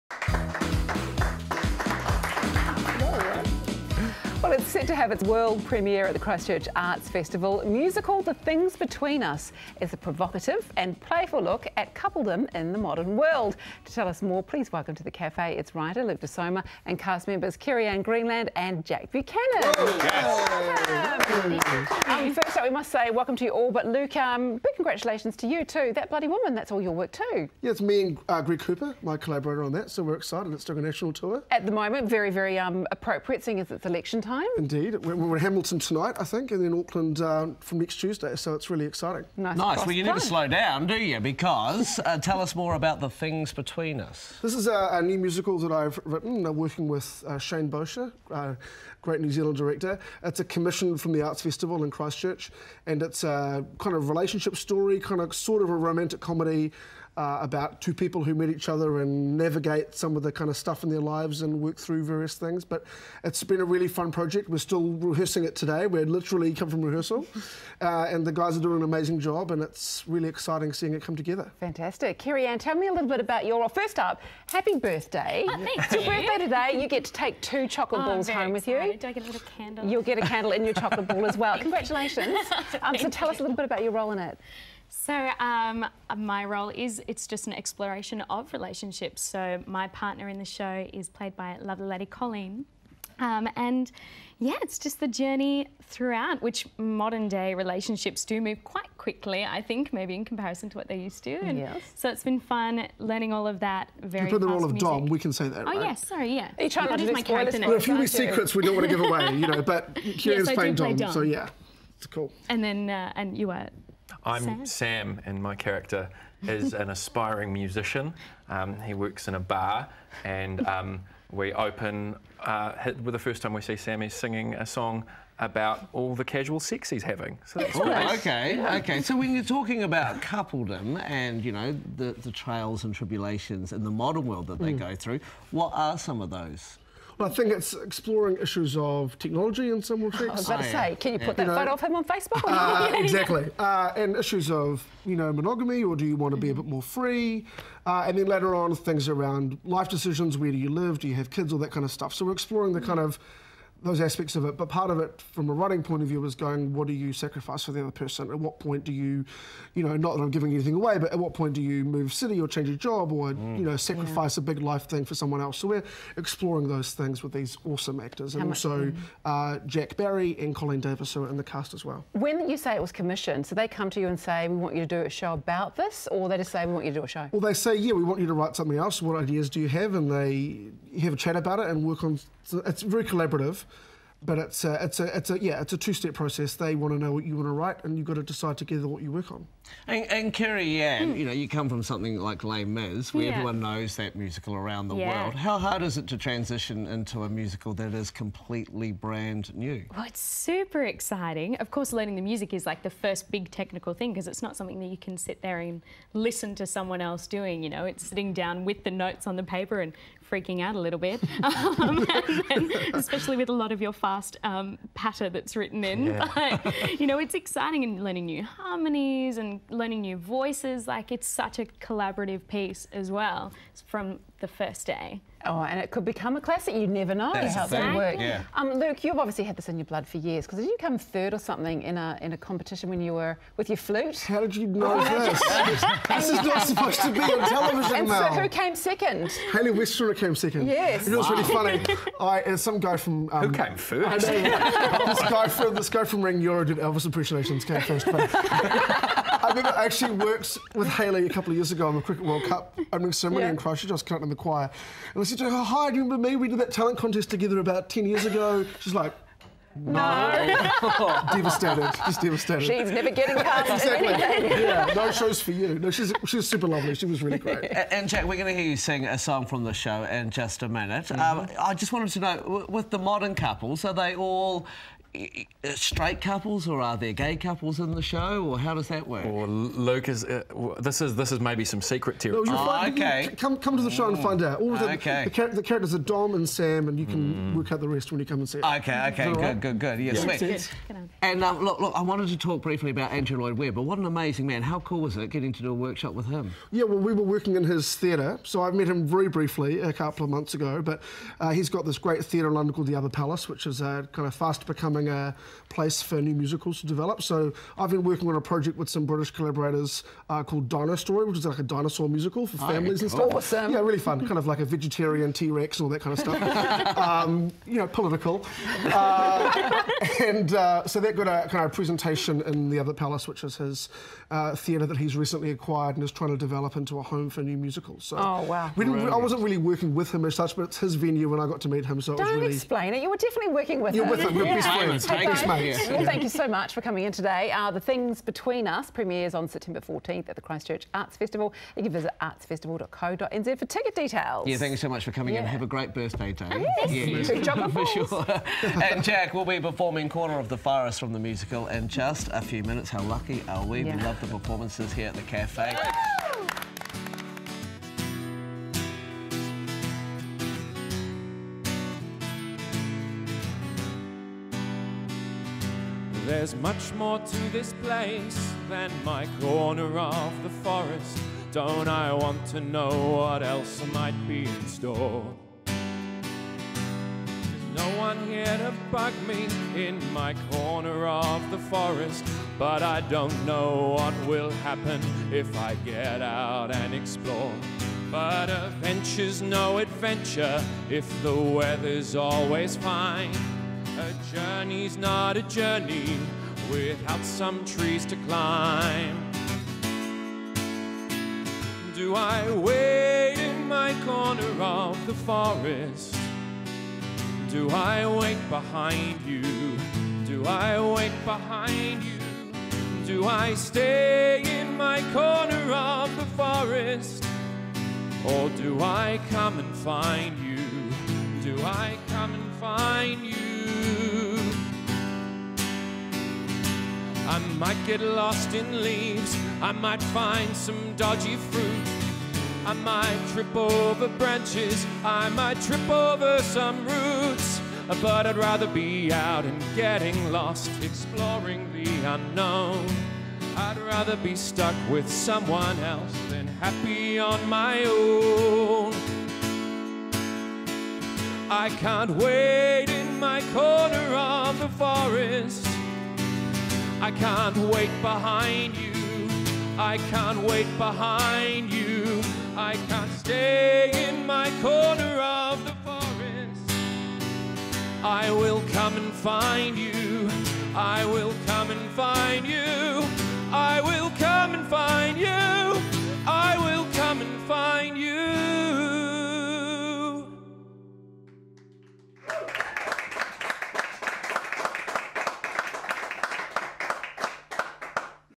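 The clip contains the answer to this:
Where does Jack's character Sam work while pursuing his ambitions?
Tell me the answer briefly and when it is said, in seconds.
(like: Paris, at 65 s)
A bar, at 119 s.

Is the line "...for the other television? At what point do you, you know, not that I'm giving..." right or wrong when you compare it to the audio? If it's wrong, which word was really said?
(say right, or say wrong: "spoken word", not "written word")
wrong: "person", not "television".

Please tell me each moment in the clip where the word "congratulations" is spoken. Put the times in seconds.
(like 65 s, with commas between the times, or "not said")
24 s, 81 s.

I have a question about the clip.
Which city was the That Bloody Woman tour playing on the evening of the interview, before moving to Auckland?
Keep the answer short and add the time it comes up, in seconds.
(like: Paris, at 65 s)
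Hamilton, at 35 s.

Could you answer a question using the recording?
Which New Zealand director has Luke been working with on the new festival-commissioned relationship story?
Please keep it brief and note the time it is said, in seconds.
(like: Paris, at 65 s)
Shane Bosher, at 47 s.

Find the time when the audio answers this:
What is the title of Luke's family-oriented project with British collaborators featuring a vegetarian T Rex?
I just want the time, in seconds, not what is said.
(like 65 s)
310 s.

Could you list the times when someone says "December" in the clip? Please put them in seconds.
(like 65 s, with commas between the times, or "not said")
not said.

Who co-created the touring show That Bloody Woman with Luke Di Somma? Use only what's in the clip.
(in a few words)
Greg Cooper.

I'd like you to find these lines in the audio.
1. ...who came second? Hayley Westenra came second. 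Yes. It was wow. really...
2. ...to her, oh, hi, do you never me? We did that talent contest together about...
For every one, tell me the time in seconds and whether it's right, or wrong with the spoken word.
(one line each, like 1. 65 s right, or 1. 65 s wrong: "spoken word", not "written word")
1. 238 s right
2. 255 s wrong: "remember", not "never".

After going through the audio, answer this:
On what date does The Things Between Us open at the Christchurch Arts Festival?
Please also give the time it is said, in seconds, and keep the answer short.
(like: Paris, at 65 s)
September 14, at 339 s.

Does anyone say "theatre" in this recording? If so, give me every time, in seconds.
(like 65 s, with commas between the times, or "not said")
297 s, 302 s, 324 s.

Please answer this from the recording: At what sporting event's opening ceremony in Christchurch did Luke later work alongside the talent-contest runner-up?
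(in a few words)
Cricket World Cup.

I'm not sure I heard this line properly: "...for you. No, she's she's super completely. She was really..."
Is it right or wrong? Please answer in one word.
wrong.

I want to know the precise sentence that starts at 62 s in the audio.
But it's been a really fun project.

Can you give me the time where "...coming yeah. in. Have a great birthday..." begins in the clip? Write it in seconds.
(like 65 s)
345 s.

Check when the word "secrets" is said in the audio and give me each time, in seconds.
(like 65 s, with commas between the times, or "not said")
108 s, 281 s.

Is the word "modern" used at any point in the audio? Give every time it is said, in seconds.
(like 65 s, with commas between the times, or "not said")
12 s, 96 s, 133 s, 272 s.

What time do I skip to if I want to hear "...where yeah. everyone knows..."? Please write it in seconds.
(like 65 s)
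193 s.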